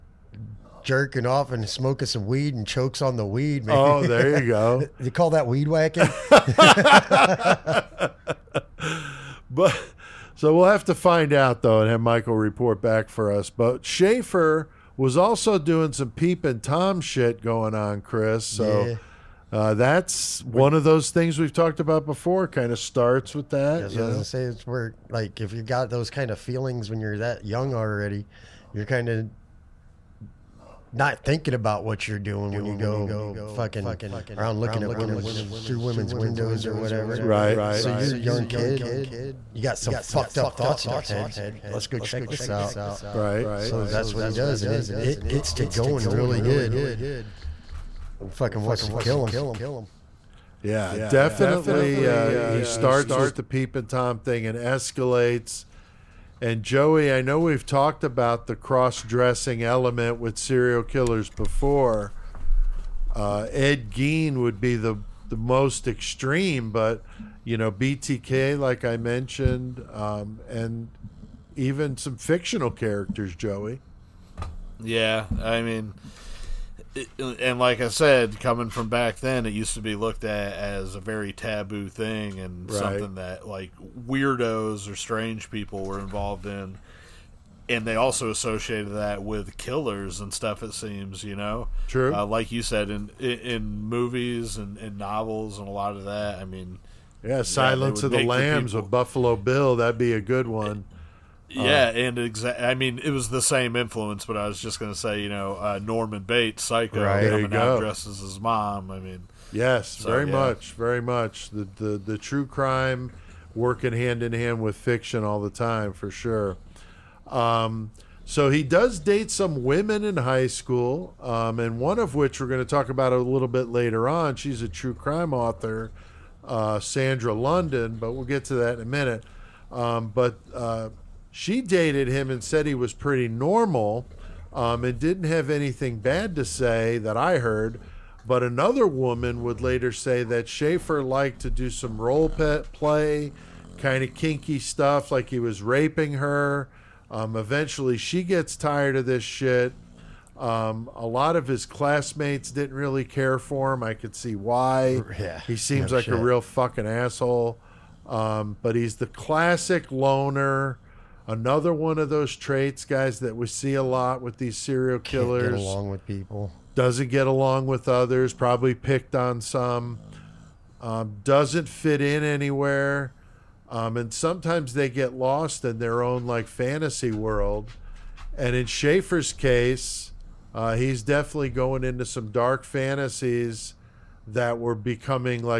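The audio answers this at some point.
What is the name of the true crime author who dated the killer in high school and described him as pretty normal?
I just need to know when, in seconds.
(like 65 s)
126 s.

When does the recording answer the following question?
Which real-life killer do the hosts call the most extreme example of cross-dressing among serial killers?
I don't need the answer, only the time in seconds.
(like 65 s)
63 s.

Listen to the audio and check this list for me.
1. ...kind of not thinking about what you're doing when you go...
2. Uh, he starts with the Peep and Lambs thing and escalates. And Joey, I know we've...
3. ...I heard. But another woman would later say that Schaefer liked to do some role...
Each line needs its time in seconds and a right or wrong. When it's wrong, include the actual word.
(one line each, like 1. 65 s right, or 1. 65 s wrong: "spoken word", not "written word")
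1. 28 s right
2. 52 s wrong: "Tom", not "Lambs"
3. 137 s right.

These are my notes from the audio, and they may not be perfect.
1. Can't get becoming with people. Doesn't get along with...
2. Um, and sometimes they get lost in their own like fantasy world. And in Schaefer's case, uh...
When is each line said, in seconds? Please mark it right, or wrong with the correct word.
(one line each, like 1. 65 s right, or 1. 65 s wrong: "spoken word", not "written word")
1. 165 s wrong: "along", not "becoming"
2. 173 s right.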